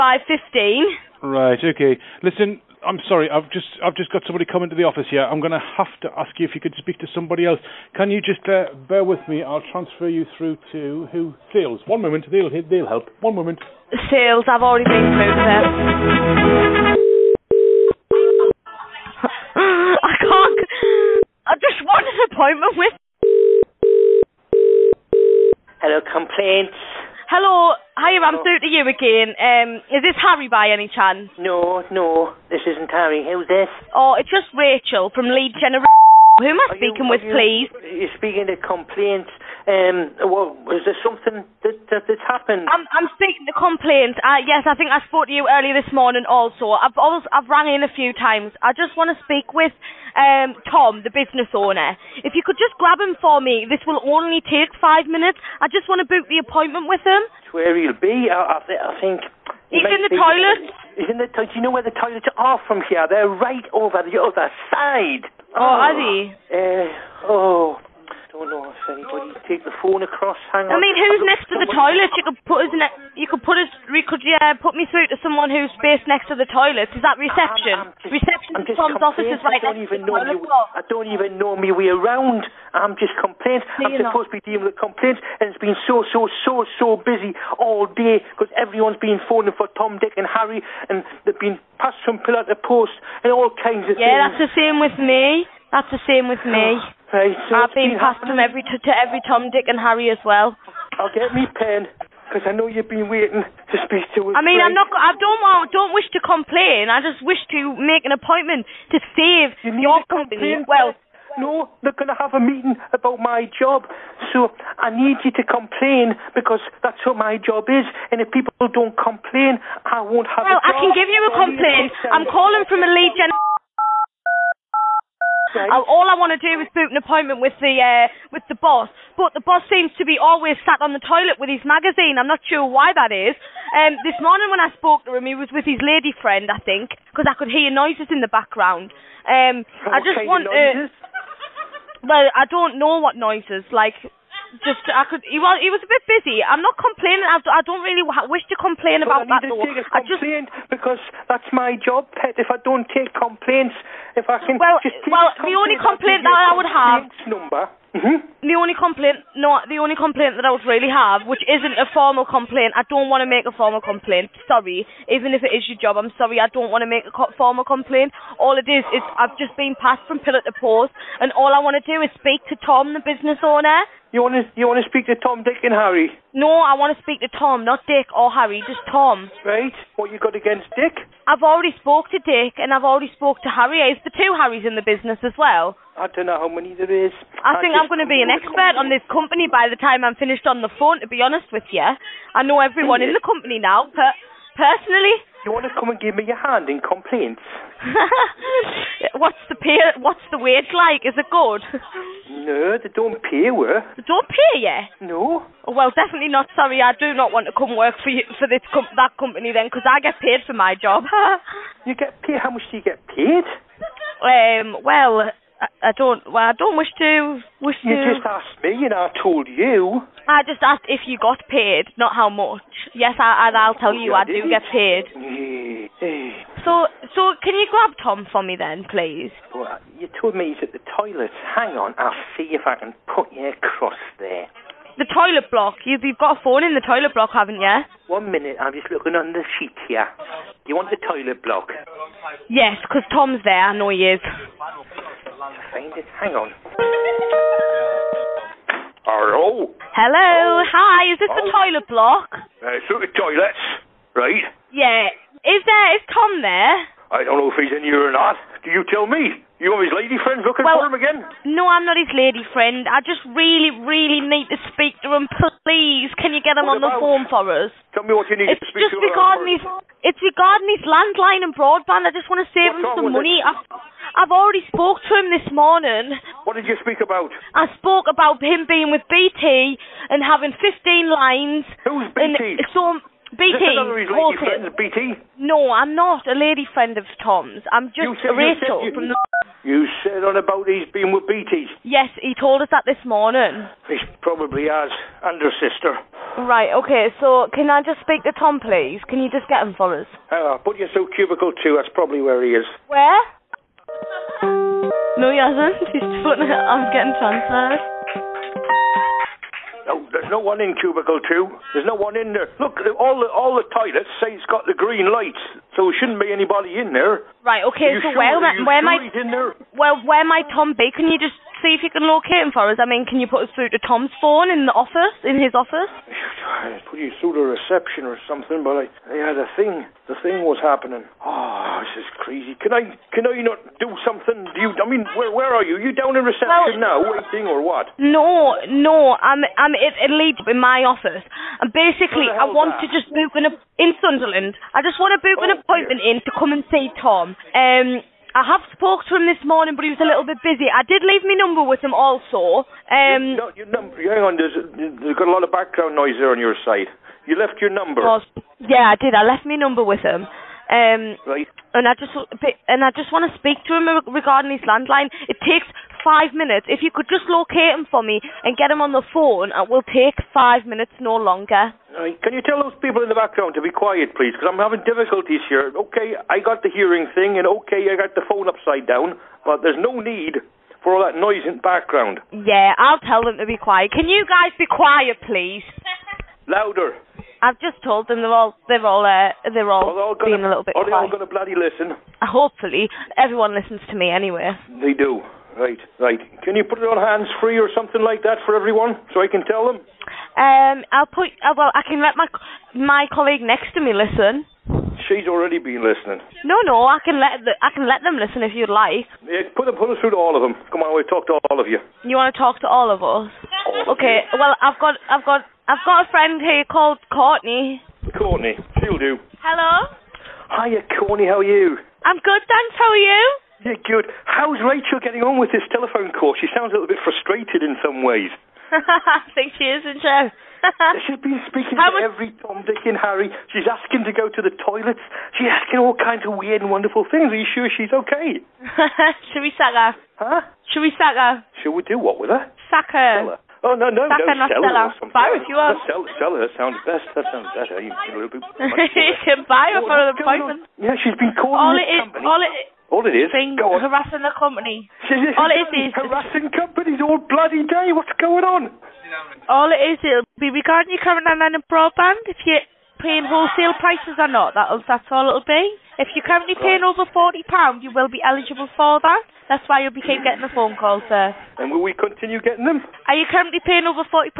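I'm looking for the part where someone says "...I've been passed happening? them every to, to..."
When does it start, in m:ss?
1:37.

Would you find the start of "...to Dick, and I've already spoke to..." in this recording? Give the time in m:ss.
3:02.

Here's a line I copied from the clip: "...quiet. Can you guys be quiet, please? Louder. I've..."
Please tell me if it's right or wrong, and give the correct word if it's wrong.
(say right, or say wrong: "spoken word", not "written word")
right.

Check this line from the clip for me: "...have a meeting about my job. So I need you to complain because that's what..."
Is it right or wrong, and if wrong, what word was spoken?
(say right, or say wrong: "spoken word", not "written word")
right.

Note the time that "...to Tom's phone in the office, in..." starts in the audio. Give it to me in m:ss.
5:23.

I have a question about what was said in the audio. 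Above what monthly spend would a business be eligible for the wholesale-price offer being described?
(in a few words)
£40.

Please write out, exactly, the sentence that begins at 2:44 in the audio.
Sorry, even if it is your job, I'm sorry, I don't want to make a formal complaint.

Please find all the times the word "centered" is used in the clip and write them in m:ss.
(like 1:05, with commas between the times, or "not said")
not said.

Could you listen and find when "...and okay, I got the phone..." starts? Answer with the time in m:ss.
6:17.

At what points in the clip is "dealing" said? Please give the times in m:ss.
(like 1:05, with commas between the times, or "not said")
1:24.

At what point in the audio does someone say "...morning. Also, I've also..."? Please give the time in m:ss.
0:45.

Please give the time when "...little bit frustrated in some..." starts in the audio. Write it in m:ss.
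7:06.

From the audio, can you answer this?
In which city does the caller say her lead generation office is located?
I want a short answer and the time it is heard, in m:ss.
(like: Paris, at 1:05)
Sunderland, at 5:43.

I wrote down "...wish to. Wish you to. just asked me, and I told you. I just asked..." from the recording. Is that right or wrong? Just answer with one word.
right.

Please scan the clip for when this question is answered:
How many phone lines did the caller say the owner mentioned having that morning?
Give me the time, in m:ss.
4:40.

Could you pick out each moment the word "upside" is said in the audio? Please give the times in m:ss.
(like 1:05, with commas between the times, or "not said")
6:18.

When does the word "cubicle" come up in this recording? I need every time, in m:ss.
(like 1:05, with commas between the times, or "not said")
5:01, 5:10.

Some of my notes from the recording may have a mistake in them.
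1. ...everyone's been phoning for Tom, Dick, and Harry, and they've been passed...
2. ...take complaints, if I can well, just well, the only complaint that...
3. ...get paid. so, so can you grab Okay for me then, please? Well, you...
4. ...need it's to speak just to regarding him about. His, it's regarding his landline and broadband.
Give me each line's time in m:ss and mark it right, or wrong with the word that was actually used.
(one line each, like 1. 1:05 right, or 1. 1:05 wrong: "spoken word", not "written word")
1. 1:28 right
2. 2:32 right
3. 3:44 wrong: "Tom", not "Okay"
4. 4:28 right.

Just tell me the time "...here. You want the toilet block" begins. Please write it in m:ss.
3:59.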